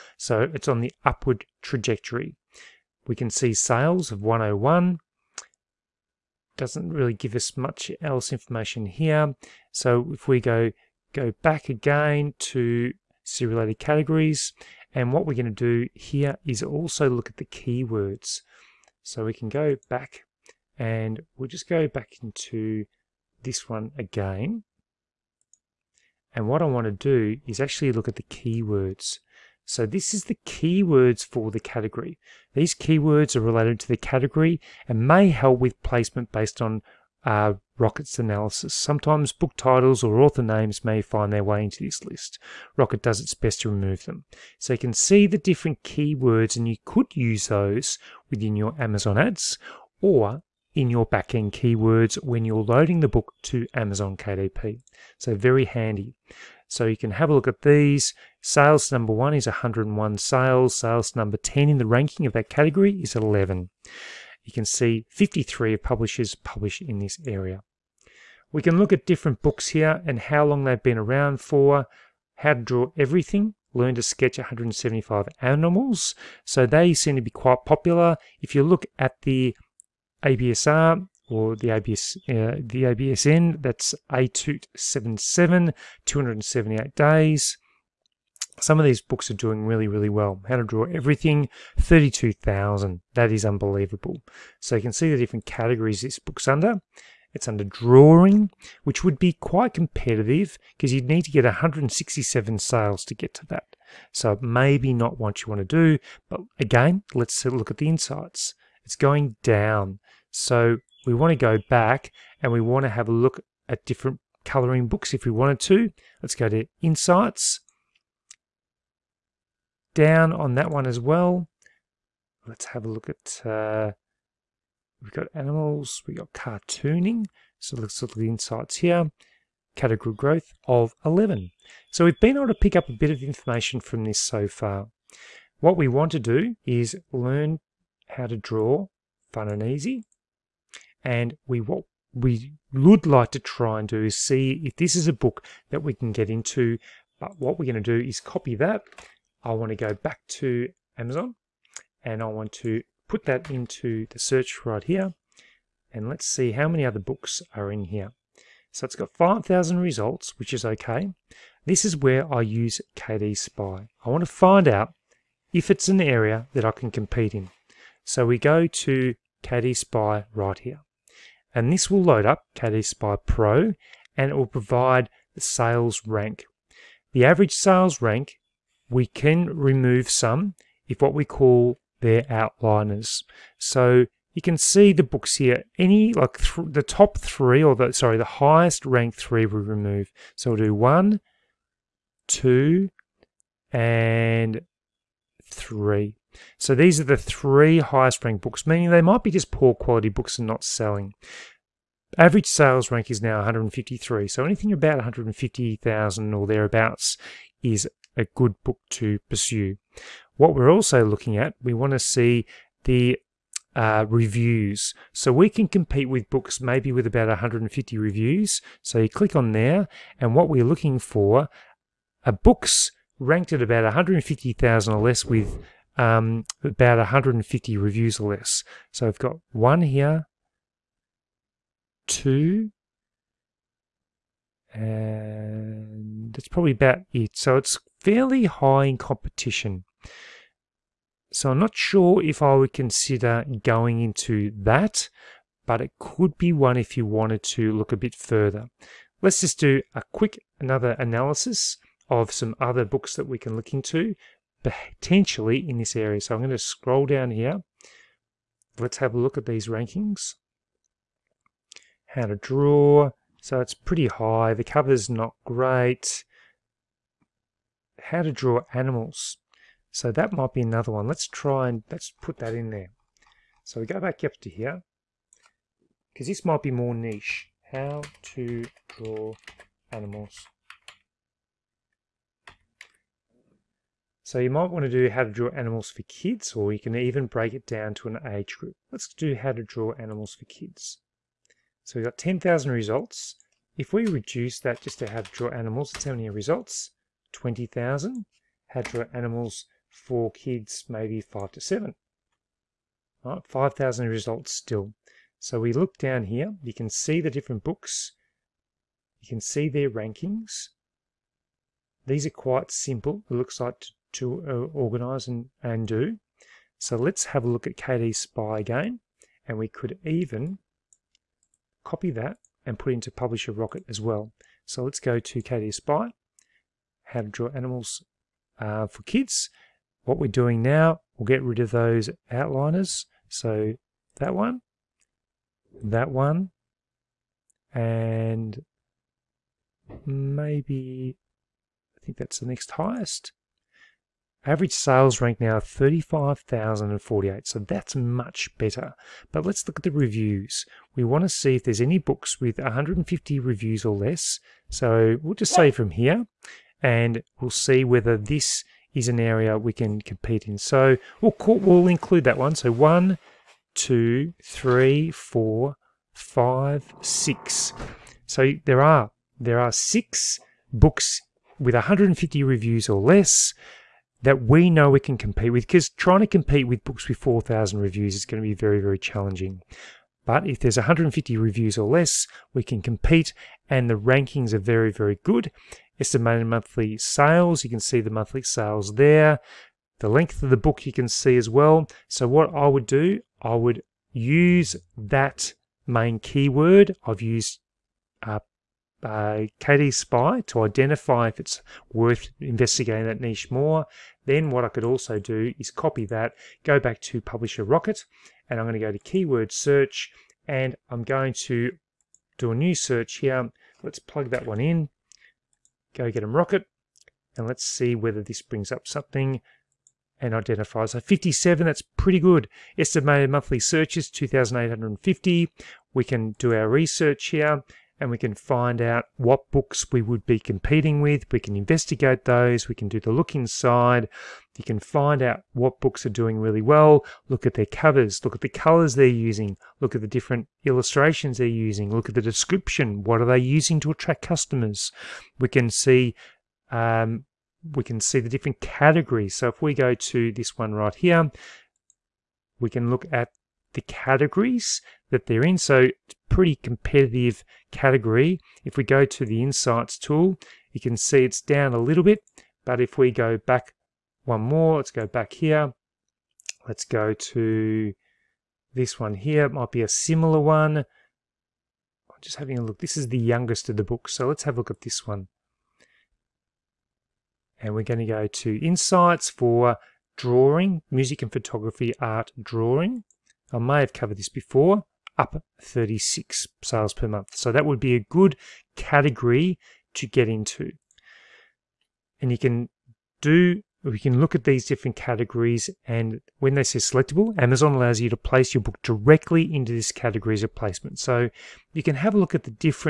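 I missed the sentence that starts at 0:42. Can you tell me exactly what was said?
Rocket does its best to remove them.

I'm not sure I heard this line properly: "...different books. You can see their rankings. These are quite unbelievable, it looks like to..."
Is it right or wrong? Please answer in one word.
wrong.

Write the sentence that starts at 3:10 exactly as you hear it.
So we'll do one, two, and three.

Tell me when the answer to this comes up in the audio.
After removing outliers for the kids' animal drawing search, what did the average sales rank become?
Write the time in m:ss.
5:45.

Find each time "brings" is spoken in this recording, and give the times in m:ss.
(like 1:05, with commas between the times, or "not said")
6:58.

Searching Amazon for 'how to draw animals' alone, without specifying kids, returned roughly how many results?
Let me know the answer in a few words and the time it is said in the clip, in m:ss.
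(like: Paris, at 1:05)
20,000, at 4:57.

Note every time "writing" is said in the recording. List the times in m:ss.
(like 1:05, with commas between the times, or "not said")
not said.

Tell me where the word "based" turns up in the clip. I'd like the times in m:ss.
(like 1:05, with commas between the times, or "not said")
0:36.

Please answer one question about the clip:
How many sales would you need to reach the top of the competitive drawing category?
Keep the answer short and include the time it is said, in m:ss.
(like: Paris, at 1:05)
167, at 1:41.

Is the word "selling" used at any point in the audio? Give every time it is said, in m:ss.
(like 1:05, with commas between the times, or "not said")
3:20.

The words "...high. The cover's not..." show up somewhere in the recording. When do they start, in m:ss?
4:24.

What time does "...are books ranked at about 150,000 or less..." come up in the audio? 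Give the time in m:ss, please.
3:42.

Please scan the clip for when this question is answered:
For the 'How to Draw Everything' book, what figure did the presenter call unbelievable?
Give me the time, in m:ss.
1:31.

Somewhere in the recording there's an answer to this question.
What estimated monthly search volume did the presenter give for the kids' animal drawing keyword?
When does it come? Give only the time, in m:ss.
7:04.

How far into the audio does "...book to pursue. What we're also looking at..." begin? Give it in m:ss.
3:28.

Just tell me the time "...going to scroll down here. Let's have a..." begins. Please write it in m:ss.
4:16.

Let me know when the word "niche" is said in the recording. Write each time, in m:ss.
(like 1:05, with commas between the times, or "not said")
4:36, 6:43.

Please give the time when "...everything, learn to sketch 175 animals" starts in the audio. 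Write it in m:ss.
1:12.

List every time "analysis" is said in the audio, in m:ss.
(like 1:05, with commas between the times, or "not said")
0:38, 4:10.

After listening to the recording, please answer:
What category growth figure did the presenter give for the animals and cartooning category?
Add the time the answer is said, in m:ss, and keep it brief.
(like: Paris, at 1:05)
11, at 2:09.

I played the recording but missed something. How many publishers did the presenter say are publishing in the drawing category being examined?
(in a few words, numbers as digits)
53.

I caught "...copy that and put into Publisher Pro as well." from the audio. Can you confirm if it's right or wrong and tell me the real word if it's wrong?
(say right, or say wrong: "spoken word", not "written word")
wrong: "Rocket", not "Pro".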